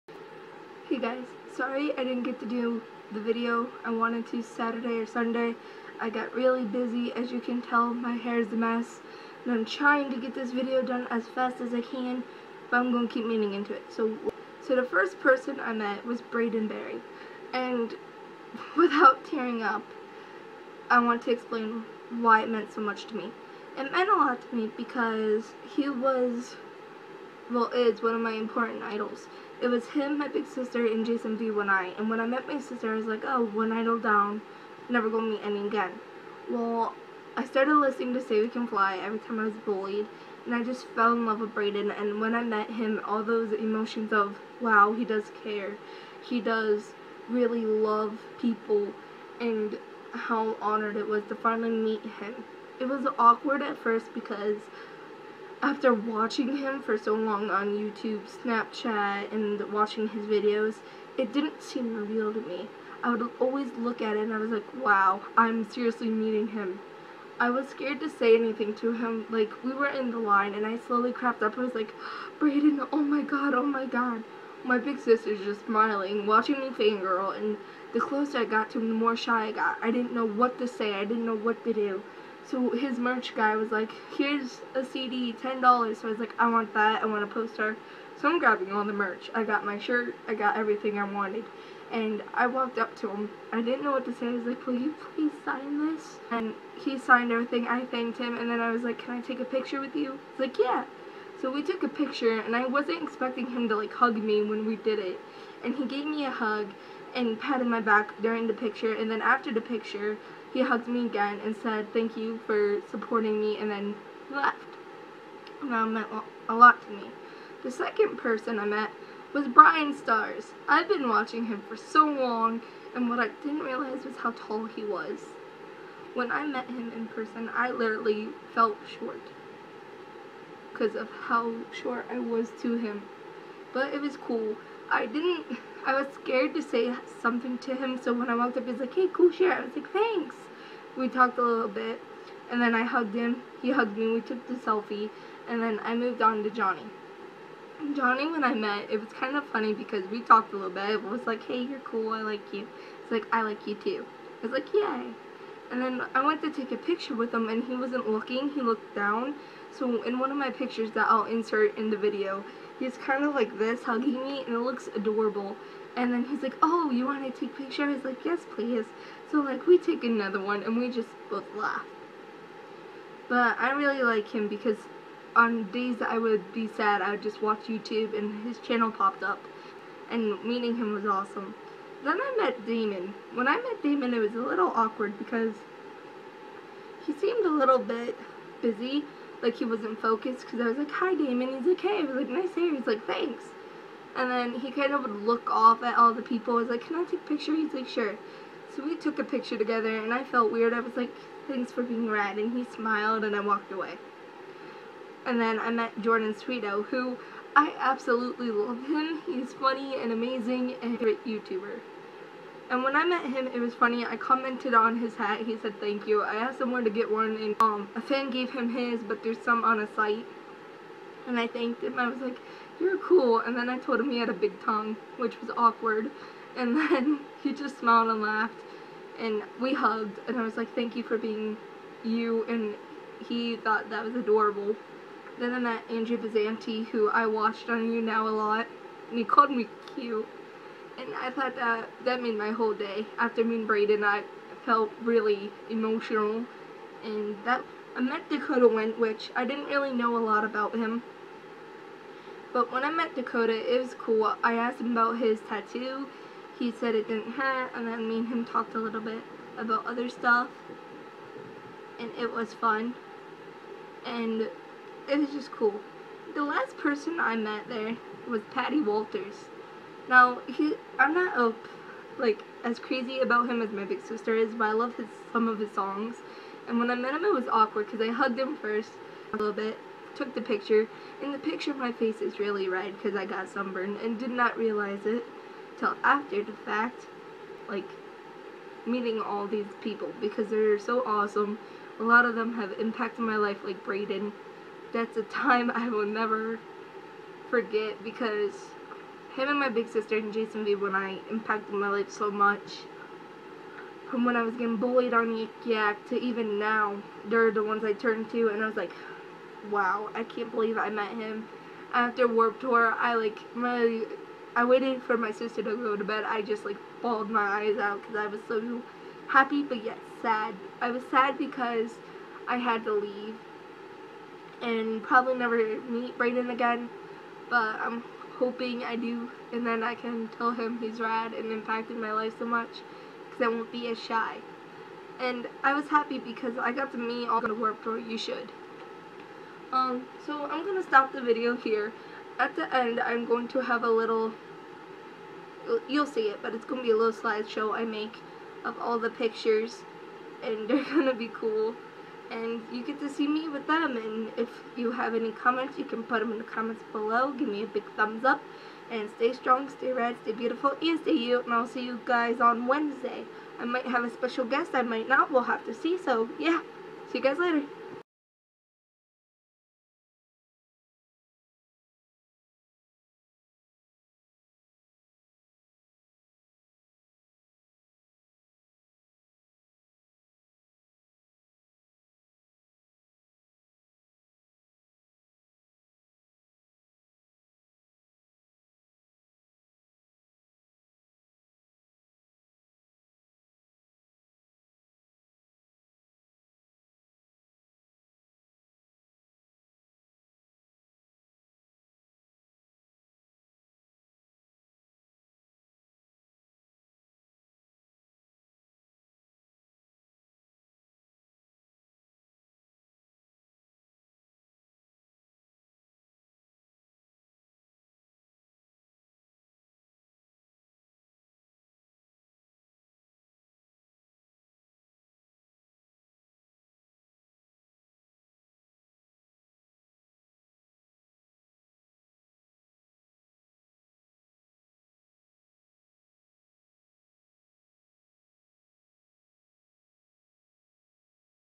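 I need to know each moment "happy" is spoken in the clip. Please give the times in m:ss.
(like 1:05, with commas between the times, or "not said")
5:19, 5:35.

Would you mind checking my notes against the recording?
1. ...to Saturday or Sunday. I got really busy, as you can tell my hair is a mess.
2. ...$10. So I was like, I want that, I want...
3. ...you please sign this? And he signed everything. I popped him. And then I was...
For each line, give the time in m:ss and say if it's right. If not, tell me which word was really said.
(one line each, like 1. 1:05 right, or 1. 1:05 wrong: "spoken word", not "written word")
1. 0:04 right
2. 1:25 right
3. 1:34 wrong: "thanked", not "popped".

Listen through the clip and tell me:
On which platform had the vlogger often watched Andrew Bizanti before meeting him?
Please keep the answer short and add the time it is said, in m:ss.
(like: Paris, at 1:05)
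YouNow, at 3:57.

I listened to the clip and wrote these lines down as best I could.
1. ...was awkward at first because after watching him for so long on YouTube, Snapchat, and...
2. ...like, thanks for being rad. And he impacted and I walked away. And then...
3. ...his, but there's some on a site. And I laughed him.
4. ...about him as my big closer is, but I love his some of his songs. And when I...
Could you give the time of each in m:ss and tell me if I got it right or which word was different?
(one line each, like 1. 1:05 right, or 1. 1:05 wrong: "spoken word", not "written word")
1. 0:52 right
2. 3:20 wrong: "smiled", not "impacted"
3. 3:38 wrong: "thanked", not "laughed"
4. 4:33 wrong: "sister", not "closer".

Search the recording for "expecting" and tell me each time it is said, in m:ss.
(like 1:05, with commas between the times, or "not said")
1:43.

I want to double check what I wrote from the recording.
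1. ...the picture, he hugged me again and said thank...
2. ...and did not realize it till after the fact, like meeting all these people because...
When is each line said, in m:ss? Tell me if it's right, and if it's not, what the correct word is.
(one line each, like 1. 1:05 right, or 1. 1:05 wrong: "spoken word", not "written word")
1. 1:49 right
2. 4:44 right.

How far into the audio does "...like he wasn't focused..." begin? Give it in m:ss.
3:09.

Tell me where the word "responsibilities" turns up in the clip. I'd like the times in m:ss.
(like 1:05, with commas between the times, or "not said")
not said.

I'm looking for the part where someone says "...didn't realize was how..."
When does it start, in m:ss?
2:03.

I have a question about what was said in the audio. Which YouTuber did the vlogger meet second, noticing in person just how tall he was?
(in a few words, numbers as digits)
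Bryan Stars.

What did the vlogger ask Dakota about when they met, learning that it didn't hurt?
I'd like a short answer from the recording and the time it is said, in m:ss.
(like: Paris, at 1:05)
his tattoo, at 4:15.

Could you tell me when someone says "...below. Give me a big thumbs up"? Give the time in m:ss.
5:56.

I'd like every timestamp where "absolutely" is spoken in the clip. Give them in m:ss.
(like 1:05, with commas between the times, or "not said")
3:27.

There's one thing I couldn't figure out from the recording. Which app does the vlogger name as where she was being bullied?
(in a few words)
Yik Yak.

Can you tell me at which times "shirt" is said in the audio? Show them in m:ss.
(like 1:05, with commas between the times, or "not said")
1:29, 2:19.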